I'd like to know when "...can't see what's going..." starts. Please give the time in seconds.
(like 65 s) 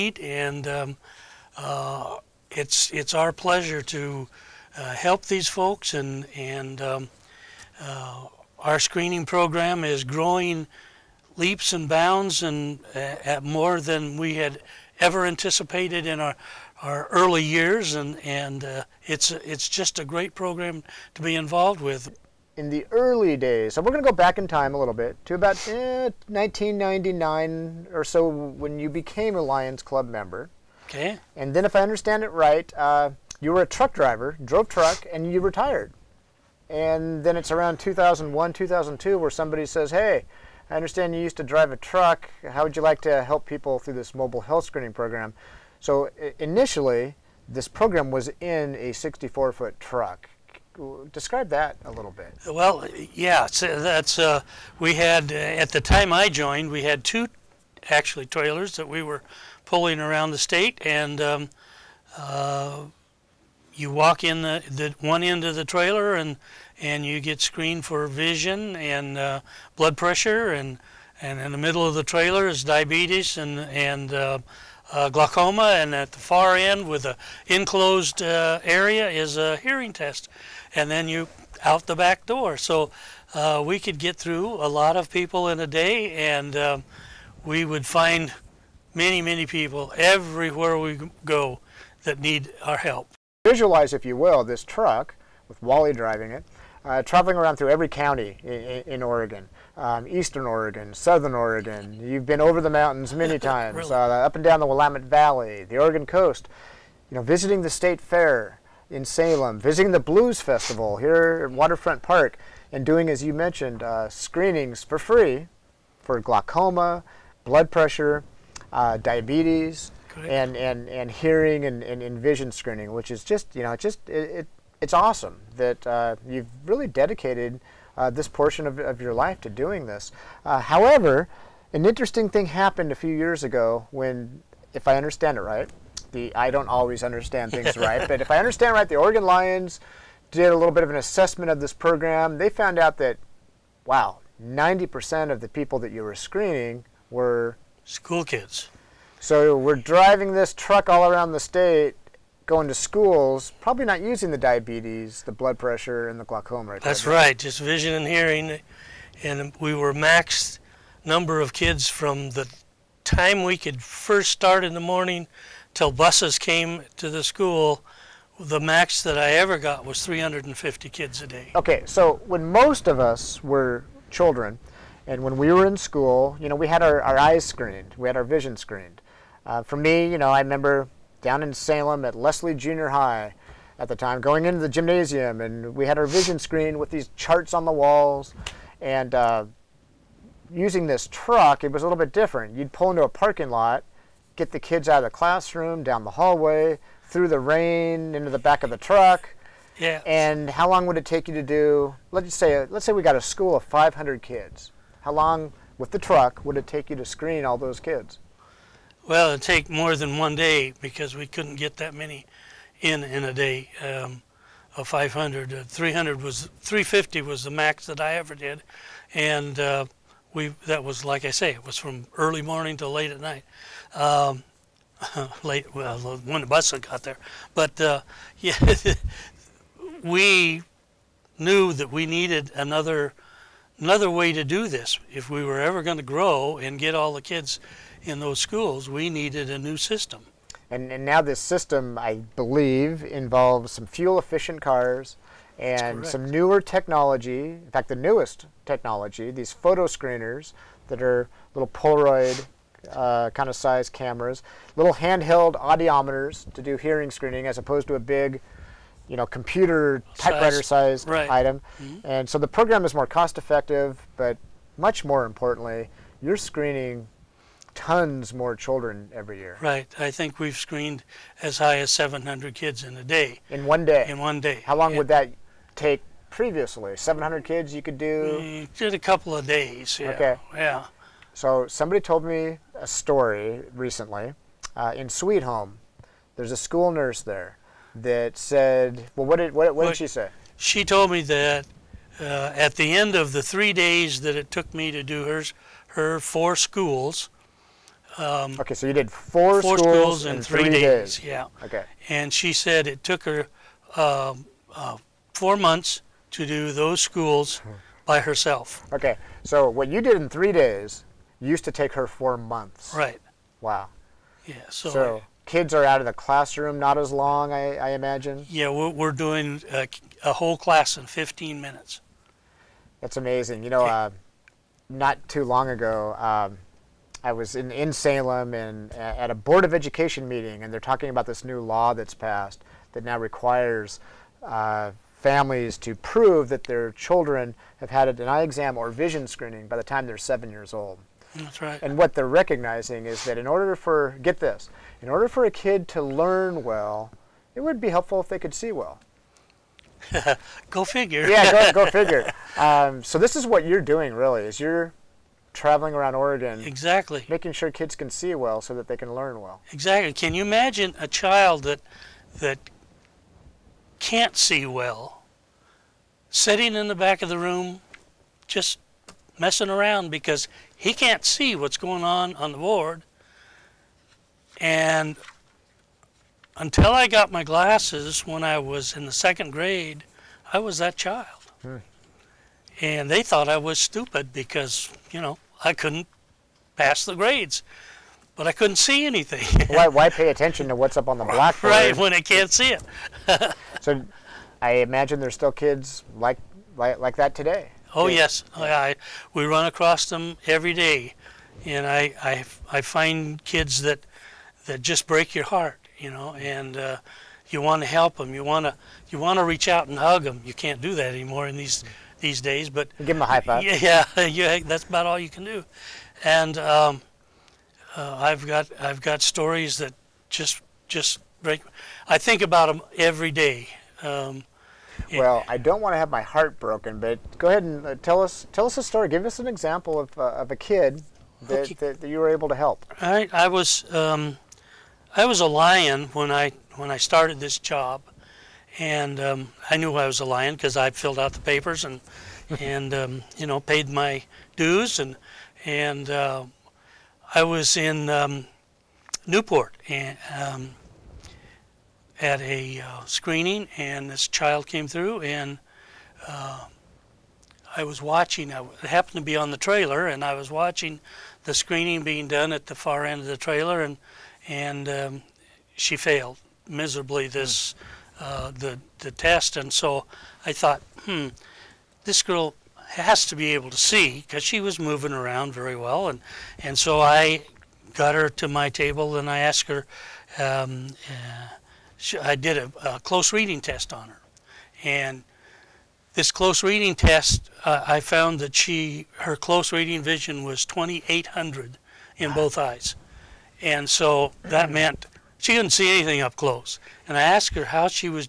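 370 s.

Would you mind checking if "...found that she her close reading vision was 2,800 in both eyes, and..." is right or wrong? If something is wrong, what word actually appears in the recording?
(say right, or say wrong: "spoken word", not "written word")
right.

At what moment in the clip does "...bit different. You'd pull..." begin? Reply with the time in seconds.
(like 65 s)
191 s.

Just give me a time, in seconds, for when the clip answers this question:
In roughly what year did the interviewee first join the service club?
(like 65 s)
26 s.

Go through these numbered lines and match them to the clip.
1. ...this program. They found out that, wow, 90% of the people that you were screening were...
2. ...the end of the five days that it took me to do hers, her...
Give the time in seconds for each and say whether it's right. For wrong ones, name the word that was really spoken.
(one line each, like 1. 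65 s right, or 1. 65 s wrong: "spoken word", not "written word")
1. 141 s right
2. 292 s wrong: "three", not "five".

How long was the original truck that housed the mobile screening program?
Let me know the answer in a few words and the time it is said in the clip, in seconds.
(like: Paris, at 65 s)
64 foot, at 48 s.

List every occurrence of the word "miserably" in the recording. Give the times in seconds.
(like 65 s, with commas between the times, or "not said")
466 s.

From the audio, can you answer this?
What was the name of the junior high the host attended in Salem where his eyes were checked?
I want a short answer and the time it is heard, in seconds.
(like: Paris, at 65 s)
Leslie, at 182 s.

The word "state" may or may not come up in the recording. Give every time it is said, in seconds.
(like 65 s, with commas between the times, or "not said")
60 s, 107 s, 151 s.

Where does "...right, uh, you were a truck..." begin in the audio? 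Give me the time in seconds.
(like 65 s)
32 s.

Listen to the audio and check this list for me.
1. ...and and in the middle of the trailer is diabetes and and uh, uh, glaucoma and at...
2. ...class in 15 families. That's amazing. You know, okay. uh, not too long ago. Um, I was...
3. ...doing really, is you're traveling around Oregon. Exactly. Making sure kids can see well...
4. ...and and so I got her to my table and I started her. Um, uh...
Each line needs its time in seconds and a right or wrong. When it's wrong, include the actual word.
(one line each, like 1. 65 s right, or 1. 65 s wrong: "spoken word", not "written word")
1. 70 s right
2. 320 s wrong: "minutes", not "families"
3. 353 s right
4. 476 s wrong: "asked", not "started".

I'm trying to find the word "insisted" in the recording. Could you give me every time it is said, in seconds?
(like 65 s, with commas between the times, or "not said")
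not said.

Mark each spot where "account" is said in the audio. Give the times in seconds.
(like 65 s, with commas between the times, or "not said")
not said.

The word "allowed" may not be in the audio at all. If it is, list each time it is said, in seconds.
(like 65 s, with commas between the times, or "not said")
not said.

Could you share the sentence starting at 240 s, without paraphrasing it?
And, and now this system, I believe, involves some fuel efficient cars and some newer technology.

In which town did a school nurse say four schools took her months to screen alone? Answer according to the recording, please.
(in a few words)
Sweet Home.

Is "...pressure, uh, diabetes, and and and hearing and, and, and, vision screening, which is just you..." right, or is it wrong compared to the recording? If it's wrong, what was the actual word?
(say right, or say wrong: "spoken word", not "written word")
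right.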